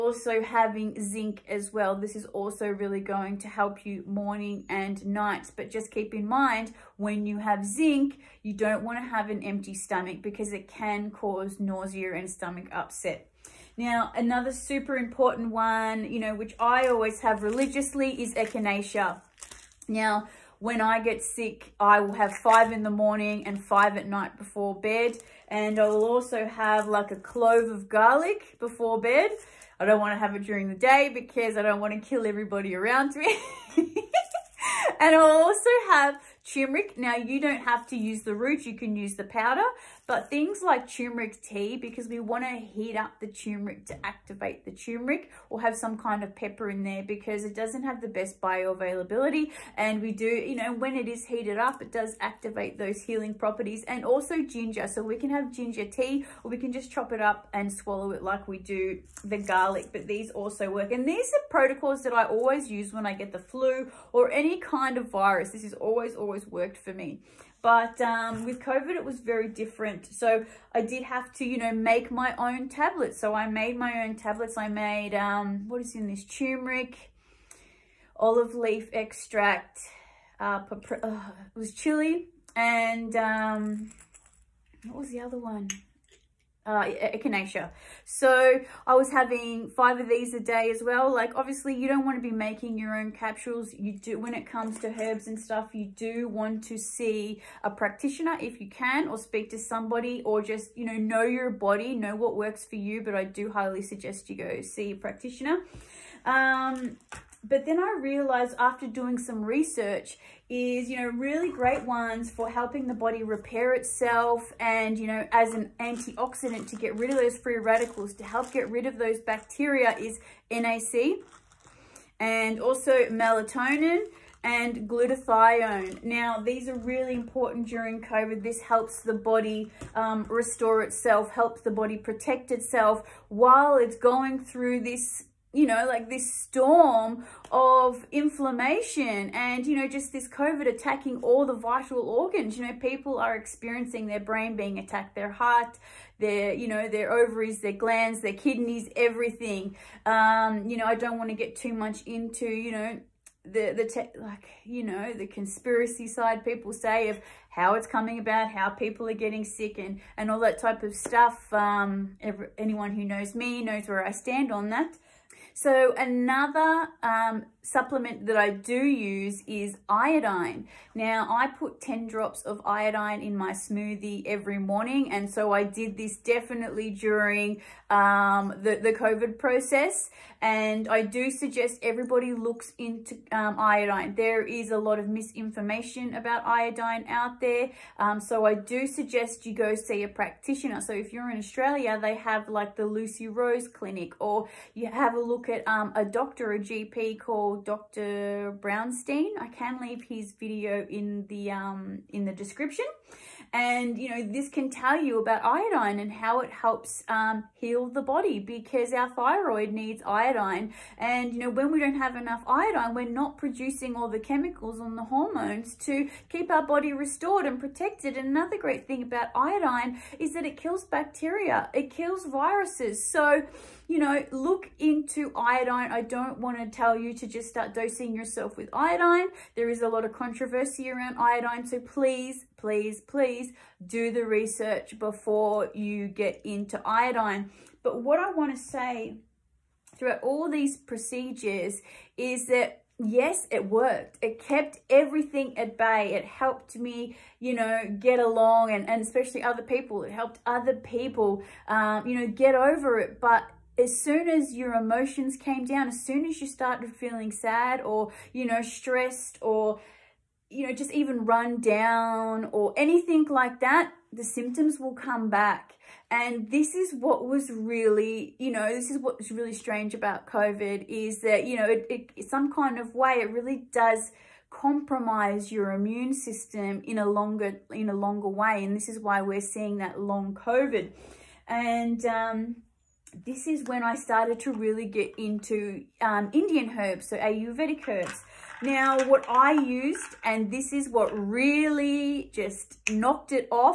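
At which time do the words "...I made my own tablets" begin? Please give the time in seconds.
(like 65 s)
73 s.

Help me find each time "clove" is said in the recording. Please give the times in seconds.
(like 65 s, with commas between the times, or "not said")
27 s.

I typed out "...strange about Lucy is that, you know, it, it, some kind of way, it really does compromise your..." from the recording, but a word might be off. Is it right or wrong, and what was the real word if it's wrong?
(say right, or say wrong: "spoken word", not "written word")
wrong: "COVID", not "Lucy".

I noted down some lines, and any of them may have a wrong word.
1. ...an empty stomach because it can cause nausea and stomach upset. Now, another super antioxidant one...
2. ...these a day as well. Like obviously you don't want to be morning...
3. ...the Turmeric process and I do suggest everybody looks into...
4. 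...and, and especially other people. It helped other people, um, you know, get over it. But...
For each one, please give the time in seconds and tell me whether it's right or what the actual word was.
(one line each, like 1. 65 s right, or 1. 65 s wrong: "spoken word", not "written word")
1. 9 s wrong: "important", not "antioxidant"
2. 90 s wrong: "making", not "morning"
3. 178 s wrong: "COVID", not "Turmeric"
4. 248 s right.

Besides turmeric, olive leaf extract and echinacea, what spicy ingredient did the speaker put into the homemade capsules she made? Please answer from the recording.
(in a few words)
chili.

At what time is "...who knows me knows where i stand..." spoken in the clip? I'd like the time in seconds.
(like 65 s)
162 s.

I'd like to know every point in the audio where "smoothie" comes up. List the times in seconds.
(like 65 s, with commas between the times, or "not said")
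173 s.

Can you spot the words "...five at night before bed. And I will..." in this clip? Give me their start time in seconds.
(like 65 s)
23 s.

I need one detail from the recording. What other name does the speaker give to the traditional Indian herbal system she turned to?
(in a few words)
Ayurvedic.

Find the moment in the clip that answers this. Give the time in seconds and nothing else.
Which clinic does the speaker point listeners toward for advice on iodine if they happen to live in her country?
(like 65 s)
192 s.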